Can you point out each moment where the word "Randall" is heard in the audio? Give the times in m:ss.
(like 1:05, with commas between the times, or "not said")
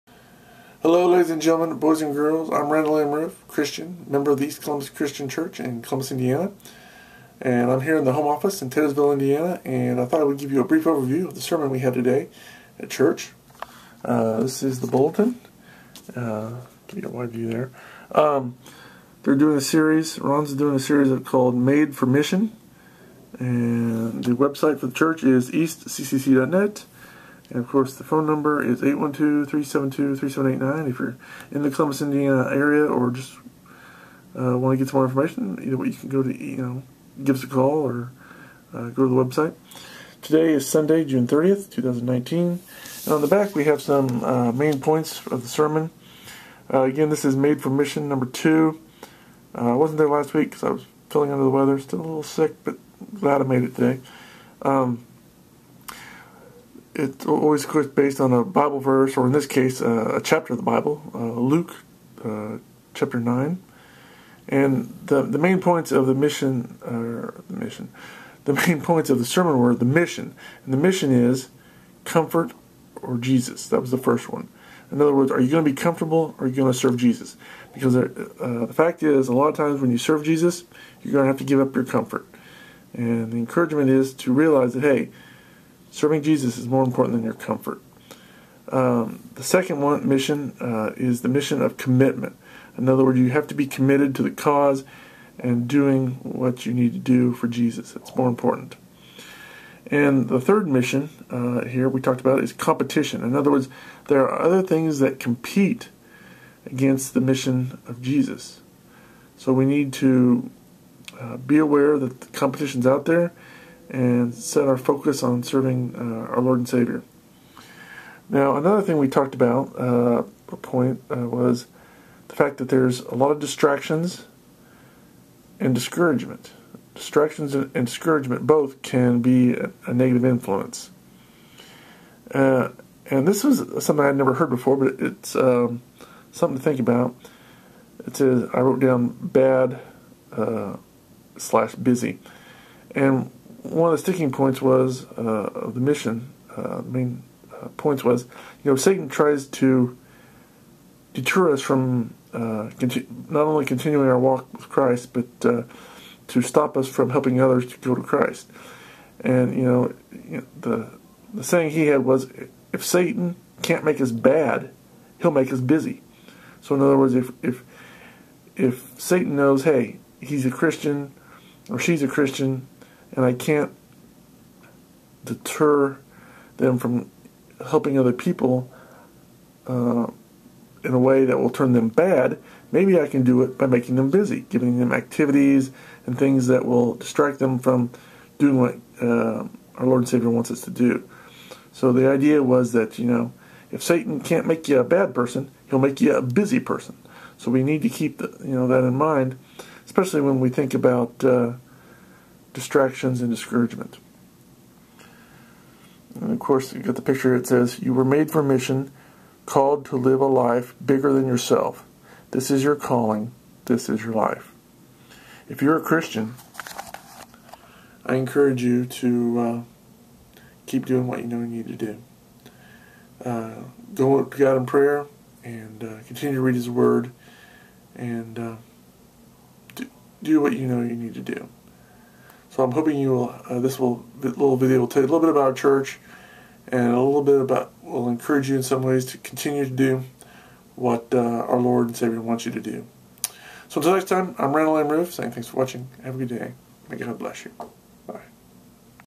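0:02, 4:04.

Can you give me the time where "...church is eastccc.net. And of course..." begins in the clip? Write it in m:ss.
0:24.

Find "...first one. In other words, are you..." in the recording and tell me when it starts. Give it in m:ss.
1:13.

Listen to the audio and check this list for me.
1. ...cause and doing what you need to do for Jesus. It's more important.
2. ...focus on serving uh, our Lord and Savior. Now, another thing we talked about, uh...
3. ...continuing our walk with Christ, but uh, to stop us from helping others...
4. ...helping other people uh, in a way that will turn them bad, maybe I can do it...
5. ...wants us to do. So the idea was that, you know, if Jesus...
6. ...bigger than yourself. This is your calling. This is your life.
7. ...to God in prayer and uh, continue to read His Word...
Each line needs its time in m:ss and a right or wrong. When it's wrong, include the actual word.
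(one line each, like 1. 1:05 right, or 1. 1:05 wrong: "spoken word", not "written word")
1. 1:34 right
2. 1:54 right
3. 2:33 right
4. 2:57 right
5. 3:10 wrong: "Satan", not "Jesus"
6. 3:30 right
7. 3:44 right.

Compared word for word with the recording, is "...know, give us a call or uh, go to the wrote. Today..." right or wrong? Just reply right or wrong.
wrong.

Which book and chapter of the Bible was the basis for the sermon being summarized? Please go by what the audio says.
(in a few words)
Luke 9.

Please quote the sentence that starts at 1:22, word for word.
And the encouragement is to realize that, hey, Serving Jesus is more important than your comfort.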